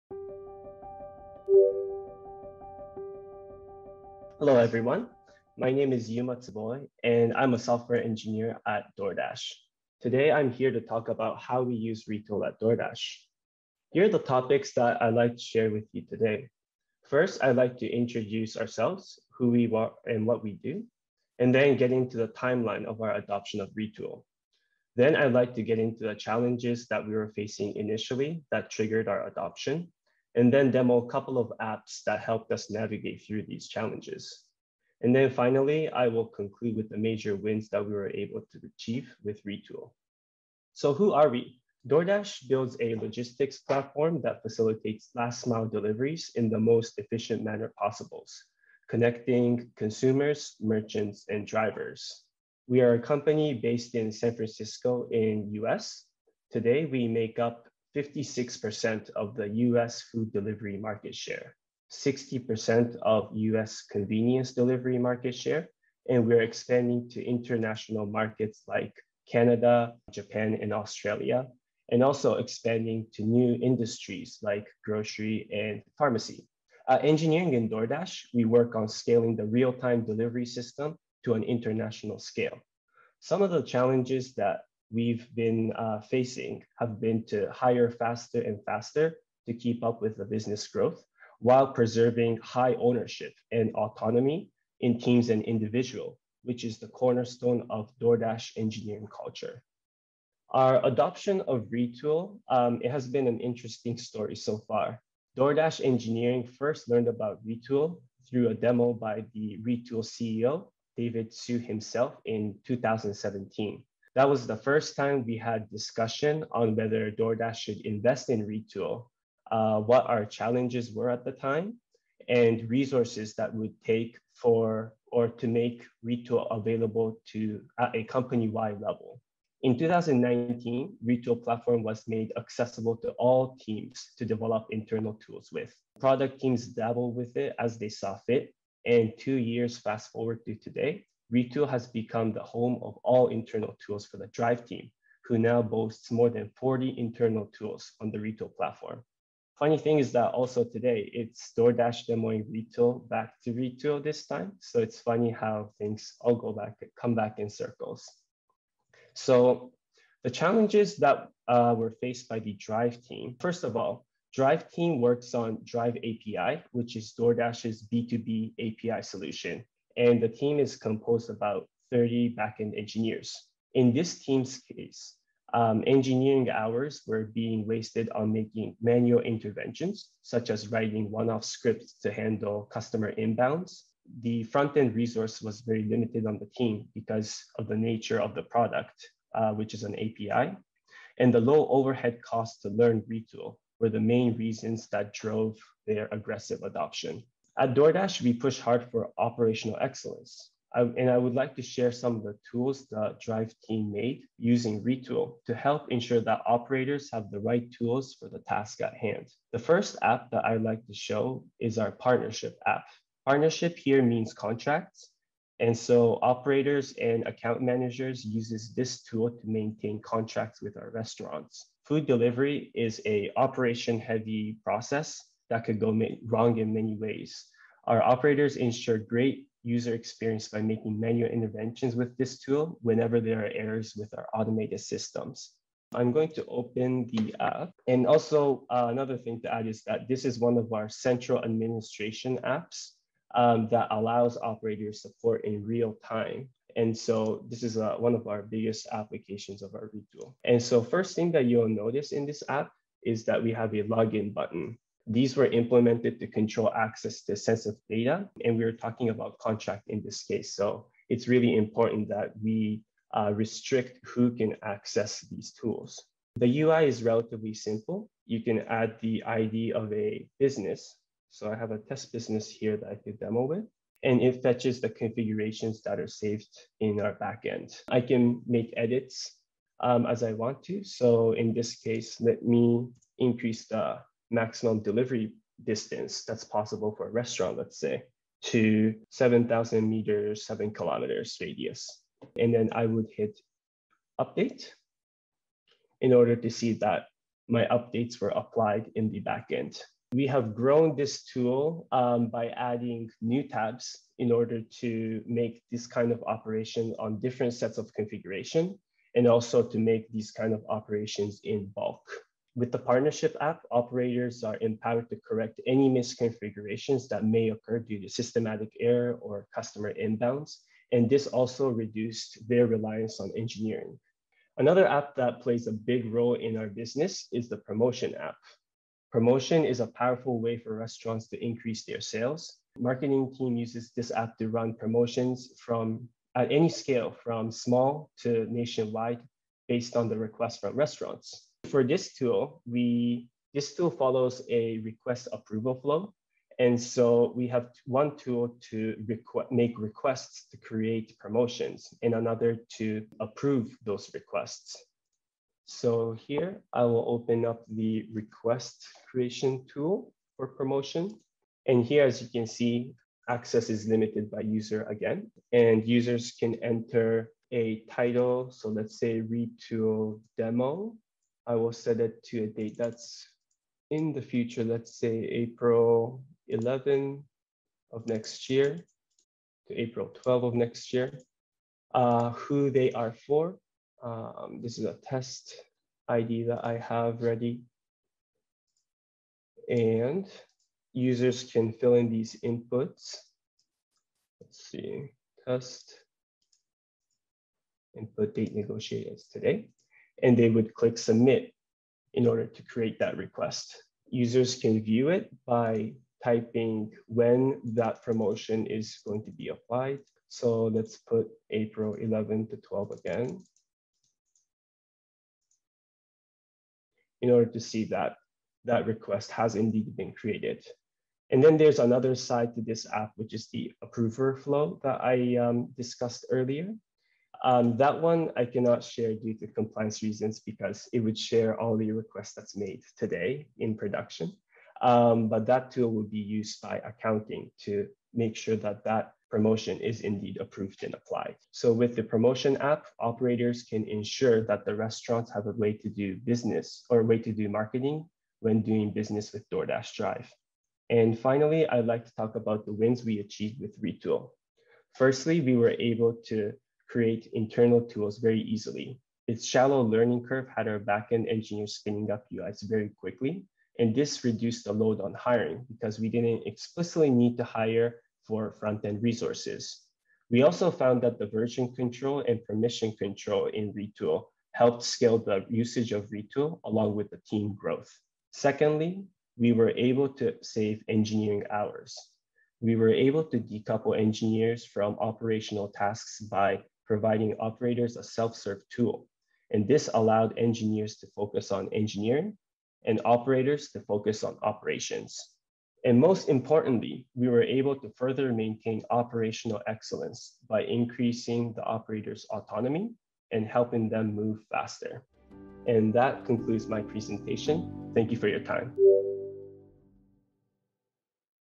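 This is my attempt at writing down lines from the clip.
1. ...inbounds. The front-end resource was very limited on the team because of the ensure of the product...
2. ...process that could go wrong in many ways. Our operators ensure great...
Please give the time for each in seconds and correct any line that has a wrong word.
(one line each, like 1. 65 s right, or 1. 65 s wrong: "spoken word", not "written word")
1. 183 s wrong: "nature", not "ensure"
2. 224 s right.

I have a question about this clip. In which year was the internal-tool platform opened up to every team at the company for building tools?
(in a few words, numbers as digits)
2019.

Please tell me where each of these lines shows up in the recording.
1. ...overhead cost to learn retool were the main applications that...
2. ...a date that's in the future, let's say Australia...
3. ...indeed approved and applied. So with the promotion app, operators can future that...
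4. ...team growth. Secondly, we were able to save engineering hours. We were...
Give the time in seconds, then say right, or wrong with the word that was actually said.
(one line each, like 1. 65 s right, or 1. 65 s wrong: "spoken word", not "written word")
1. 191 s wrong: "reasons", not "applications"
2. 372 s wrong: "April", not "Australia"
3. 440 s wrong: "ensure", not "future"
4. 477 s right.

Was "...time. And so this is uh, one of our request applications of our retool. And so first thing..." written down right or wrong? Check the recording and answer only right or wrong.
wrong.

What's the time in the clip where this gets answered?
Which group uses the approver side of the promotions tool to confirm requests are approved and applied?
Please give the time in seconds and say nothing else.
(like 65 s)
436 s.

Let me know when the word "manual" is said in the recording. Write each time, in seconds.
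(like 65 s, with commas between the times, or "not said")
178 s, 230 s.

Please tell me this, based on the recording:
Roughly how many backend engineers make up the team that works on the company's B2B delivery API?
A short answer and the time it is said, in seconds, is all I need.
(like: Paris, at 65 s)
About 30, at 171 s.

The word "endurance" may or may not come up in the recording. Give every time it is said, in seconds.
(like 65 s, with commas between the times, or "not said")
not said.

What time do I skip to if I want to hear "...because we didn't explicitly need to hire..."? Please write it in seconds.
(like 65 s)
465 s.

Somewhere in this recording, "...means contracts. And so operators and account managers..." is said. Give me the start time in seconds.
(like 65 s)
214 s.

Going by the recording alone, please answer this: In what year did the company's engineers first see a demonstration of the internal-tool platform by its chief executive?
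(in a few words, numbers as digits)
2017.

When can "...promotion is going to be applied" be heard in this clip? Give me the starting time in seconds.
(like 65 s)
408 s.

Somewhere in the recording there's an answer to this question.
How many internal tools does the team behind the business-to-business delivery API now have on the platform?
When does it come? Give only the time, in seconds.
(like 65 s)
146 s.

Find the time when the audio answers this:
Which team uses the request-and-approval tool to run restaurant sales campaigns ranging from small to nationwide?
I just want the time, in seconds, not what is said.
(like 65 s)
332 s.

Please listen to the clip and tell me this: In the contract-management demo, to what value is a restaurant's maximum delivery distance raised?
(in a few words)
7,000 meters.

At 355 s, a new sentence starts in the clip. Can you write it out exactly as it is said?
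So here I will open up the request creation tool for promotion.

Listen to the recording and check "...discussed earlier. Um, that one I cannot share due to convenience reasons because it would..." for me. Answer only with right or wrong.
wrong.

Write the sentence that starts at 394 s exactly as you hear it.
Let's see, test input date negotiators today and they would click submit in order to create that request.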